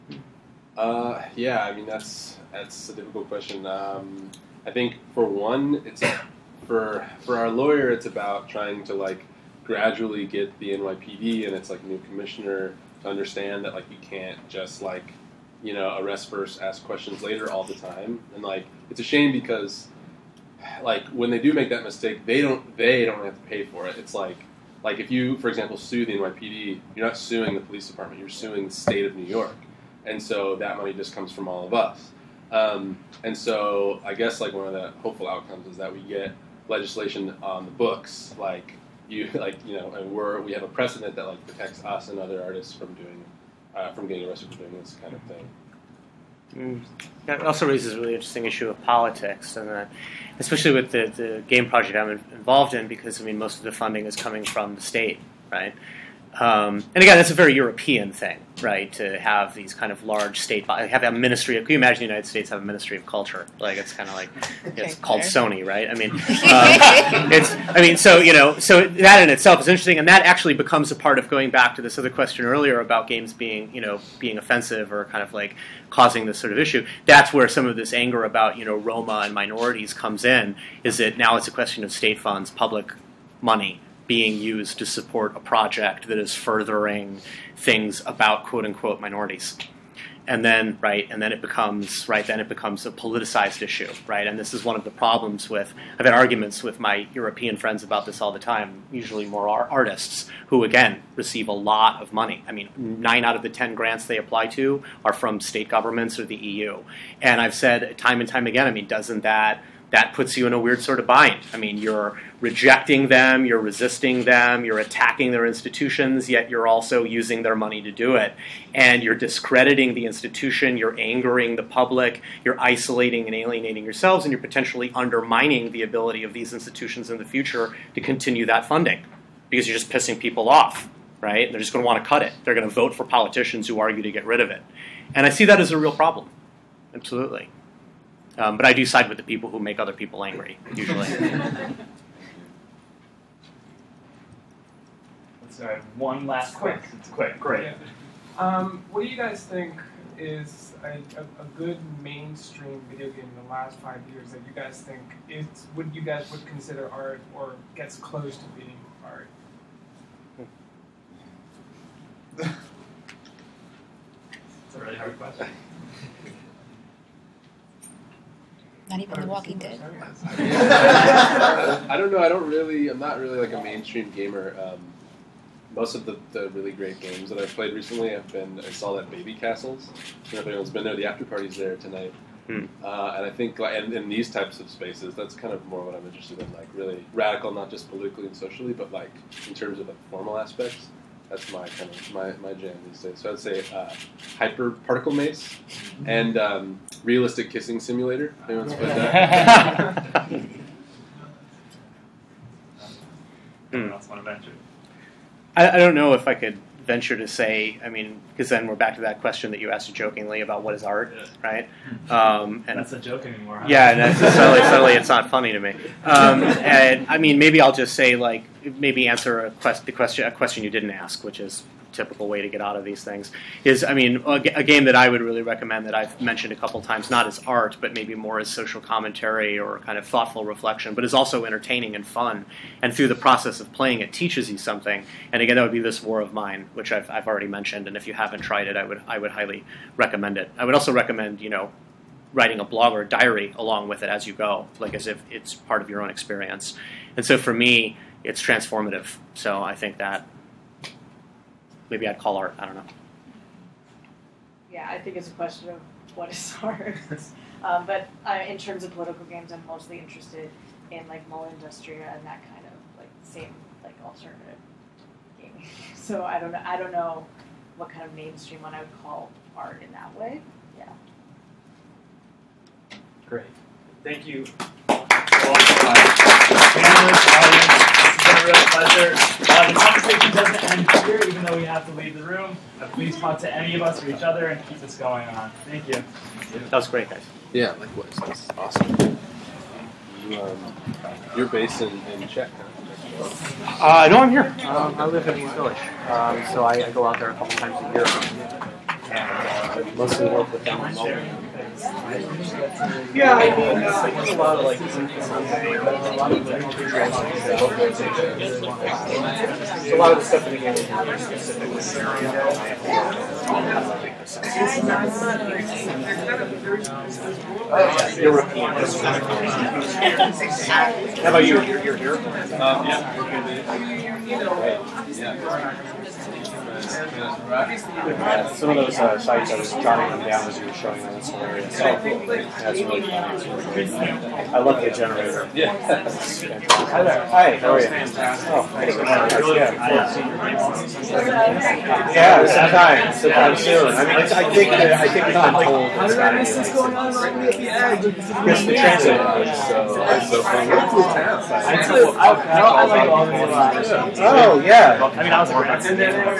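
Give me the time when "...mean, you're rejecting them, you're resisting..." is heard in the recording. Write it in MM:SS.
01:51.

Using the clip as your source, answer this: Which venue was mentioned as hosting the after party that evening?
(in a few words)
Babycastles.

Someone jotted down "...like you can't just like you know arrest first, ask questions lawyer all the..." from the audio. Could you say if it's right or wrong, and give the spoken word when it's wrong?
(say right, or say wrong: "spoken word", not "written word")
wrong: "later", not "lawyer".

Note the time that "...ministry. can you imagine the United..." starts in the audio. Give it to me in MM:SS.
01:01.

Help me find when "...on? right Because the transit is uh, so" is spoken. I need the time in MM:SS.
05:46.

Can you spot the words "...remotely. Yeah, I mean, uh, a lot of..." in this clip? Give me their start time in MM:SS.
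05:00.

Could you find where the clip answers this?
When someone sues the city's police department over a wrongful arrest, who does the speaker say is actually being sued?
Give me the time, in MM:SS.
00:28.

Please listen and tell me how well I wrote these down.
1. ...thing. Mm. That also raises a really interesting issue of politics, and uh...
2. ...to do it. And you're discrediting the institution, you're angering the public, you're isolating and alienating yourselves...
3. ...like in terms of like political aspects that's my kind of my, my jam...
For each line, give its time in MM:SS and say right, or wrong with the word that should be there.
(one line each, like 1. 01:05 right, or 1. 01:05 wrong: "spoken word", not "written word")
1. 00:45 right
2. 01:57 right
3. 03:08 wrong: "formal", not "political".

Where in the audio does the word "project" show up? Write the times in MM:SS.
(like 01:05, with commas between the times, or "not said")
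00:51, 01:25.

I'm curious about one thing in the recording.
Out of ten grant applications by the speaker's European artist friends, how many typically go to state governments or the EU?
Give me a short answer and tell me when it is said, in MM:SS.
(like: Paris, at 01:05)
9, at 01:42.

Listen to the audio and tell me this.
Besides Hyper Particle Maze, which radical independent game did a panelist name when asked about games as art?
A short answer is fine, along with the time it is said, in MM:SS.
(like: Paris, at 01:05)
Realistic Kissing Simulator, at 03:17.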